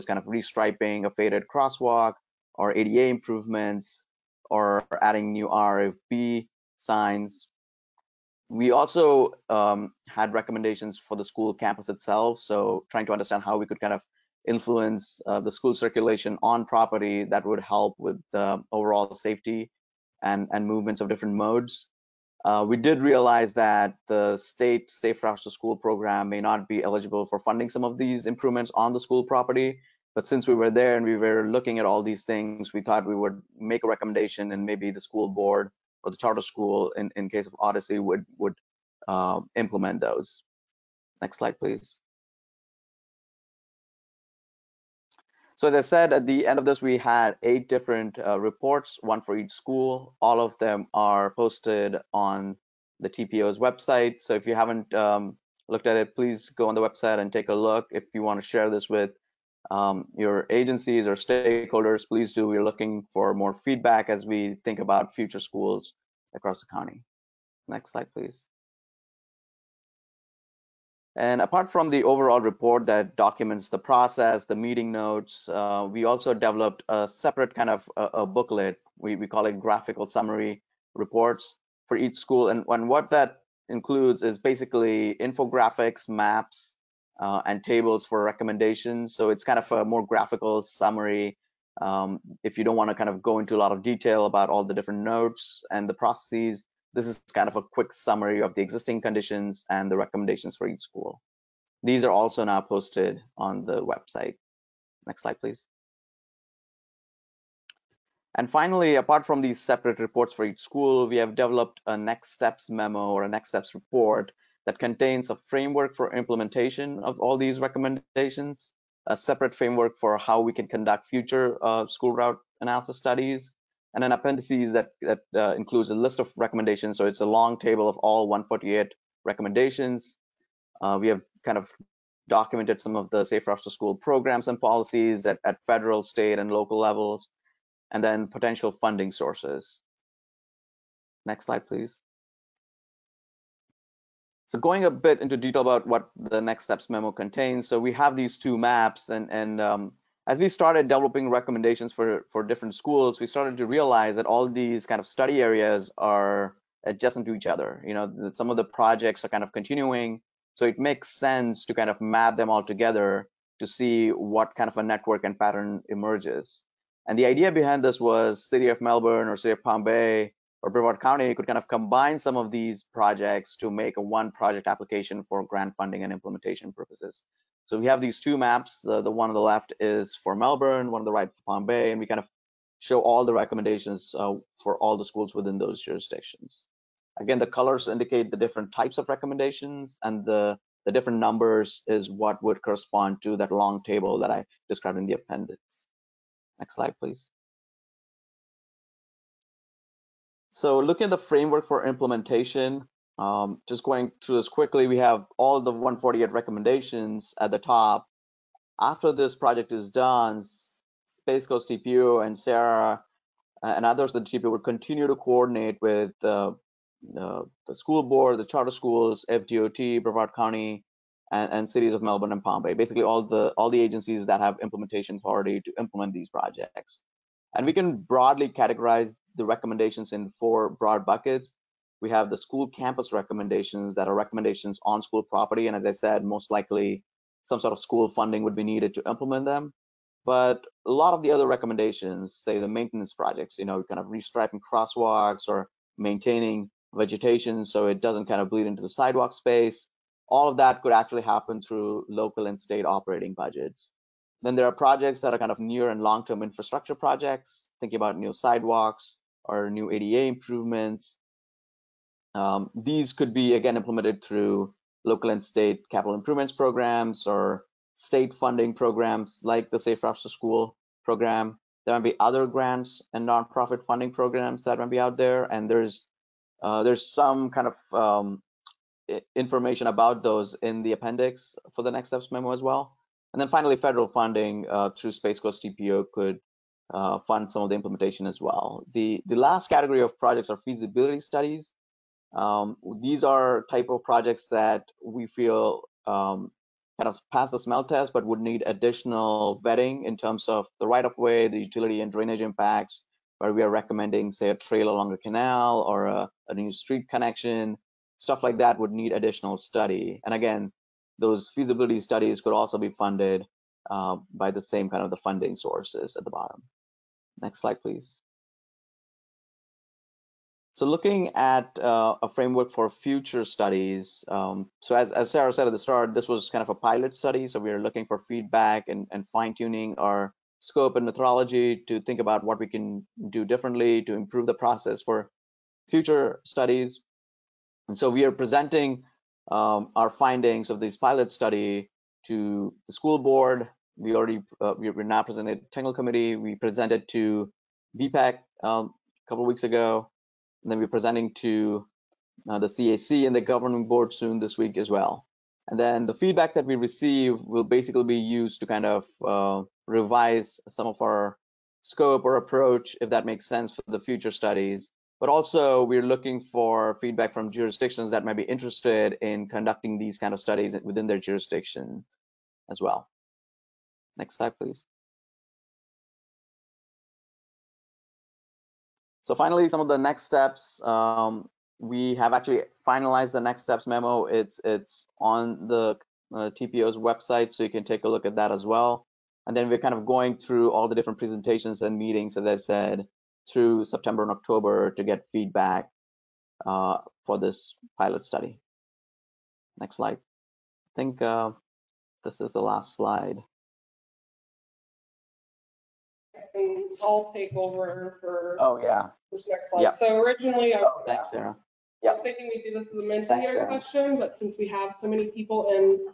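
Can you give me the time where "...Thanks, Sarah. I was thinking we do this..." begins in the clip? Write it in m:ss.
6:51.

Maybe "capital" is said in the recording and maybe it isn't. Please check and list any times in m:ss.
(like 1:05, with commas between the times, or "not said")
4:25.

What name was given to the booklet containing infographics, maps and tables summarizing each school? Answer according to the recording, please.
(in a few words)
graphical summary reports.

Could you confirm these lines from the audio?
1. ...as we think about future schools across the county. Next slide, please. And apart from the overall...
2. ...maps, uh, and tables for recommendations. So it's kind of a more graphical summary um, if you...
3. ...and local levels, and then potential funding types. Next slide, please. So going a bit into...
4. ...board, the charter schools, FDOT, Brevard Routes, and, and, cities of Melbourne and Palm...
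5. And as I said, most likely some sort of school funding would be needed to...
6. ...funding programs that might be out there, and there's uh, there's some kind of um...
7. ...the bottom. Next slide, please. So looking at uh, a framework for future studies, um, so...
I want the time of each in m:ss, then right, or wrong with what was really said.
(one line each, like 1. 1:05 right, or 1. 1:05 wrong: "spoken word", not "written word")
1. 1:04 right
2. 1:26 right
3. 2:16 wrong: "sources", not "types"
4. 3:38 wrong: "County", not "Routes"
5. 3:55 right
6. 4:33 right
7. 5:16 right.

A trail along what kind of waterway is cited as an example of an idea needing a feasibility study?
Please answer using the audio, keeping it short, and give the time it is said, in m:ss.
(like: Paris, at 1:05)
canal, at 5:05.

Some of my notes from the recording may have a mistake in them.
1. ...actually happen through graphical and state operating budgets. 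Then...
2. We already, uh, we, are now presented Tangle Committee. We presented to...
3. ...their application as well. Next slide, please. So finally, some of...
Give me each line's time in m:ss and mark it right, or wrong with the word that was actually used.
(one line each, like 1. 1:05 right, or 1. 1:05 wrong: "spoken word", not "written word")
1. 4:10 wrong: "local", not "graphical"
2. 5:43 right
3. 6:11 wrong: "jurisdiction", not "application".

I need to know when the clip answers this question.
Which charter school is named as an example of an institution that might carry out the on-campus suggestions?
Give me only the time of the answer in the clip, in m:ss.
0:37.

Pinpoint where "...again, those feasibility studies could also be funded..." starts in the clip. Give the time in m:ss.
5:10.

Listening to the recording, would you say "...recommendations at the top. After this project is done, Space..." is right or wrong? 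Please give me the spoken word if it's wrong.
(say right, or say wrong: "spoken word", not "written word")
right.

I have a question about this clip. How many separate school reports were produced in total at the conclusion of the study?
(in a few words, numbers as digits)
8.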